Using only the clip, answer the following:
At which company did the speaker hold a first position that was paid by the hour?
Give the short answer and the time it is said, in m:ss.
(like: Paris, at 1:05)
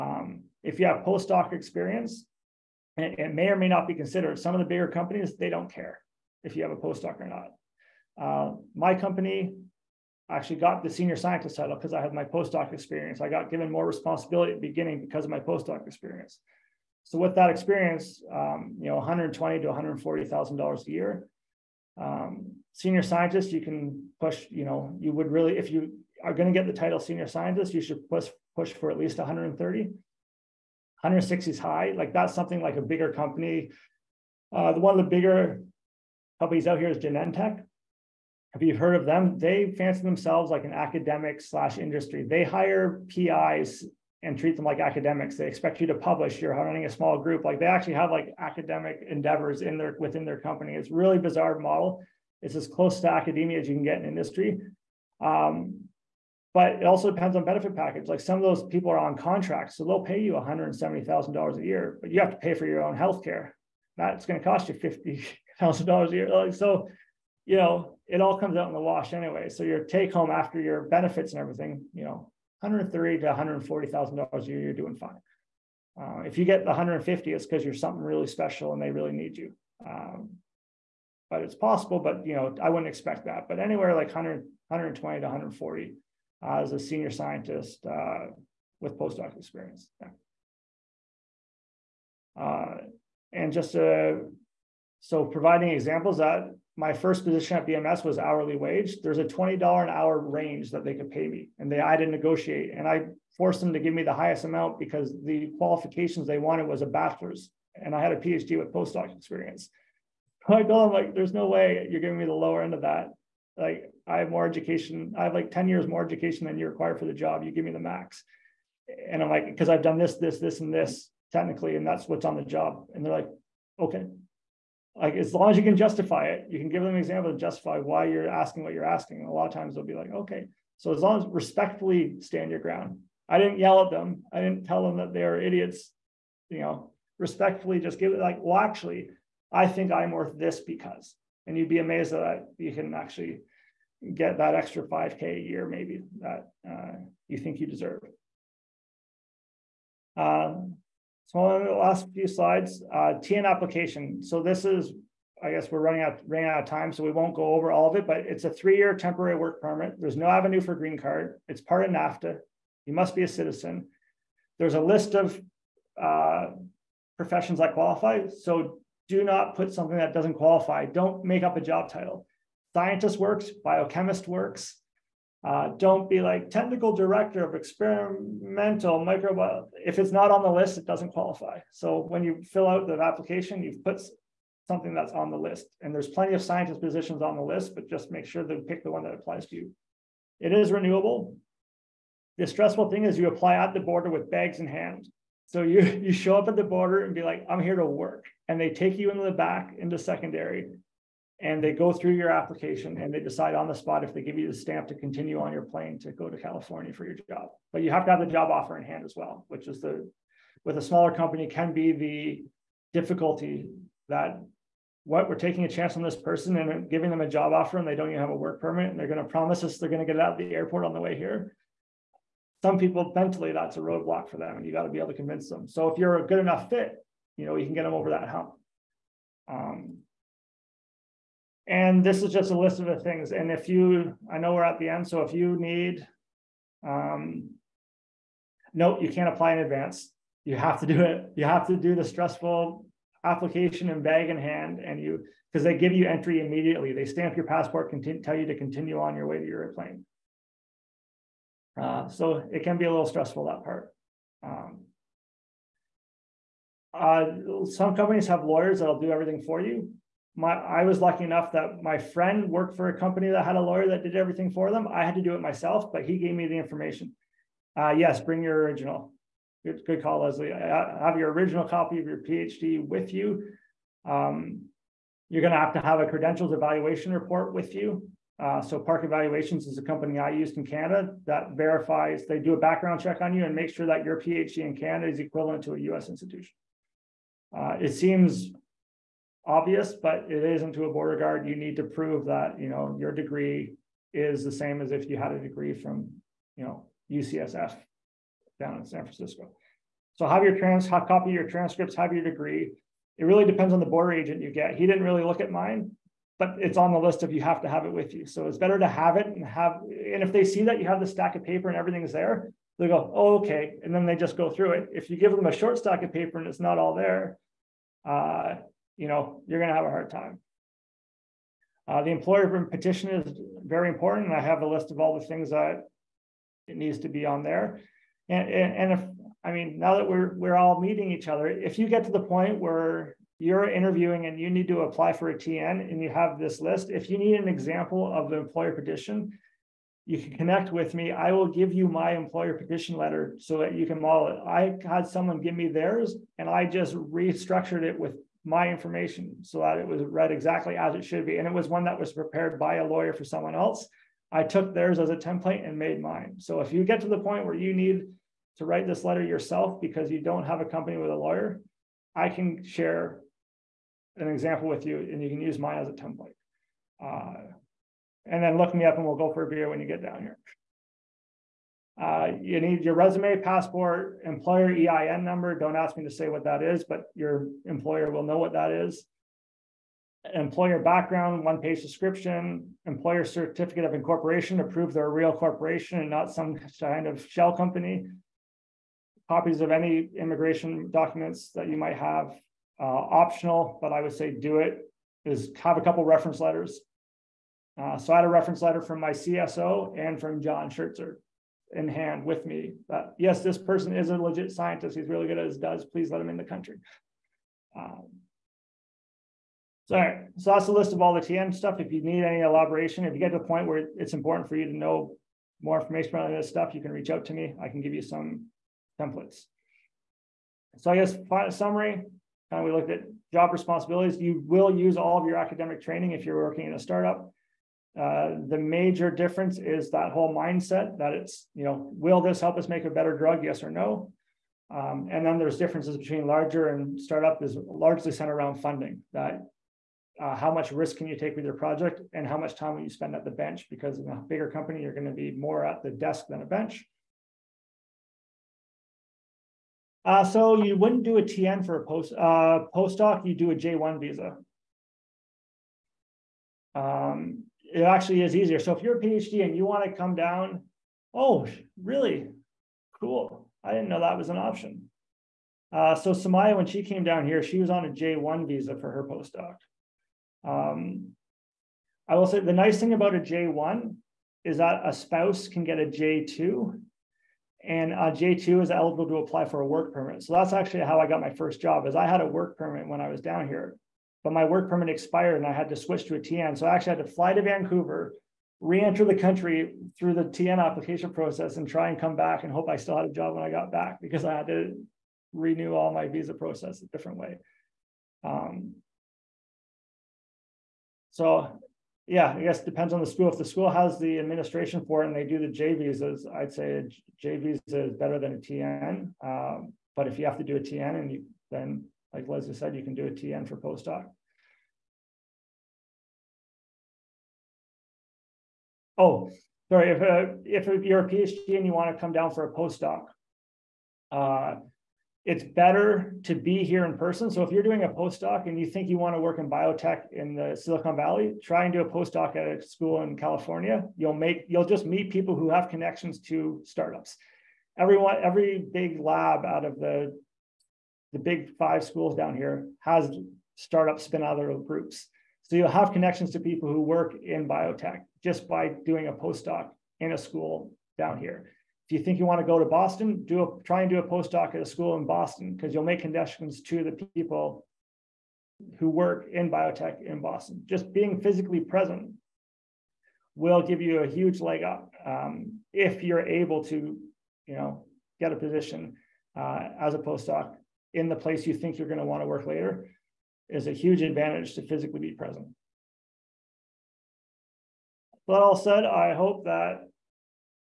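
BMS, at 1:37.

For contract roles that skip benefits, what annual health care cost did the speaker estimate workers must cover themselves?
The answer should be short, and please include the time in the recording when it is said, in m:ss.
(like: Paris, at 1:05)
$50,000, at 1:04.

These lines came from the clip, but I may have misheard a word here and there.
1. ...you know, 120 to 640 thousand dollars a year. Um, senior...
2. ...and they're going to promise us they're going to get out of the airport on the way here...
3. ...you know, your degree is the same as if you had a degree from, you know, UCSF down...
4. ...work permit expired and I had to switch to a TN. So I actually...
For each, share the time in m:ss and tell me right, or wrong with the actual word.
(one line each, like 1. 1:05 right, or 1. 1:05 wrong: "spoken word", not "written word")
1. 0:18 wrong: "140", not "640"
2. 3:38 right
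3. 4:52 right
4. 8:04 right.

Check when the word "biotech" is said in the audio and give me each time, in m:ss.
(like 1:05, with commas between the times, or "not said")
8:49, 9:07, 9:19.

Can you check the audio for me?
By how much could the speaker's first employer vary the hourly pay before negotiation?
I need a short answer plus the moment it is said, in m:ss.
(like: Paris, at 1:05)
$20 an hour, at 1:39.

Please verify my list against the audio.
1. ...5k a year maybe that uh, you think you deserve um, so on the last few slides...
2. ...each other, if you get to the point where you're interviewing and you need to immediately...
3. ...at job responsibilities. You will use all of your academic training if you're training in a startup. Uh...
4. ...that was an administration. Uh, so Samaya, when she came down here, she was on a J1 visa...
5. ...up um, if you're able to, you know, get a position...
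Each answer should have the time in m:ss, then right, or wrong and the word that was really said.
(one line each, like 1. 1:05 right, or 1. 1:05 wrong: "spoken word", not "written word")
1. 2:24 right
2. 5:31 wrong: "apply", not "immediately"
3. 7:02 wrong: "working", not "training"
4. 7:43 wrong: "option", not "administration"
5. 9:24 right.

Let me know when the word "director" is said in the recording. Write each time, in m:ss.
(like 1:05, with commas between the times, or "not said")
2:56.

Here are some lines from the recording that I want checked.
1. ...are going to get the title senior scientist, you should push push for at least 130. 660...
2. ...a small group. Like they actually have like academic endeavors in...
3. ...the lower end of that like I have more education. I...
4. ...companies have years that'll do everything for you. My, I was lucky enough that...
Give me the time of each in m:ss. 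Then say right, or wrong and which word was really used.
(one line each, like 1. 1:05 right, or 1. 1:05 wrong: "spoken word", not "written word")
1. 0:26 wrong: "160", not "660"
2. 0:46 right
3. 1:52 right
4. 4:17 wrong: "lawyers", not "years".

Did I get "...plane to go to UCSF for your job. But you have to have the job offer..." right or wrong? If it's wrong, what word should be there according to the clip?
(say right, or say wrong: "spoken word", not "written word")
wrong: "California", not "UCSF".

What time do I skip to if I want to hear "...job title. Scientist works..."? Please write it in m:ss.
2:51.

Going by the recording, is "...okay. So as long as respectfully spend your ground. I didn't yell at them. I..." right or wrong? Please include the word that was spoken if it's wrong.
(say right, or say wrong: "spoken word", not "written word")
wrong: "stand", not "spend".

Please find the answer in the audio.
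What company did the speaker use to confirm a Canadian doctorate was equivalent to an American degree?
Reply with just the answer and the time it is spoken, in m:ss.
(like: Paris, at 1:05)
Park Evaluations, at 4:38.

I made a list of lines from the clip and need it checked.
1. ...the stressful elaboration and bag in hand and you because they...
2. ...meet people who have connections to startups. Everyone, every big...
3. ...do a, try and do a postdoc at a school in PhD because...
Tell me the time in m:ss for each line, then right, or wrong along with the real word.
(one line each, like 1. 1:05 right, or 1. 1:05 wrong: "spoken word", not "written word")
1. 4:01 wrong: "application", not "elaboration"
2. 8:54 right
3. 9:13 wrong: "Boston", not "PhD".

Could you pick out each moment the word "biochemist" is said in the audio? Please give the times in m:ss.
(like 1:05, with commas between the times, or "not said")
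2:53.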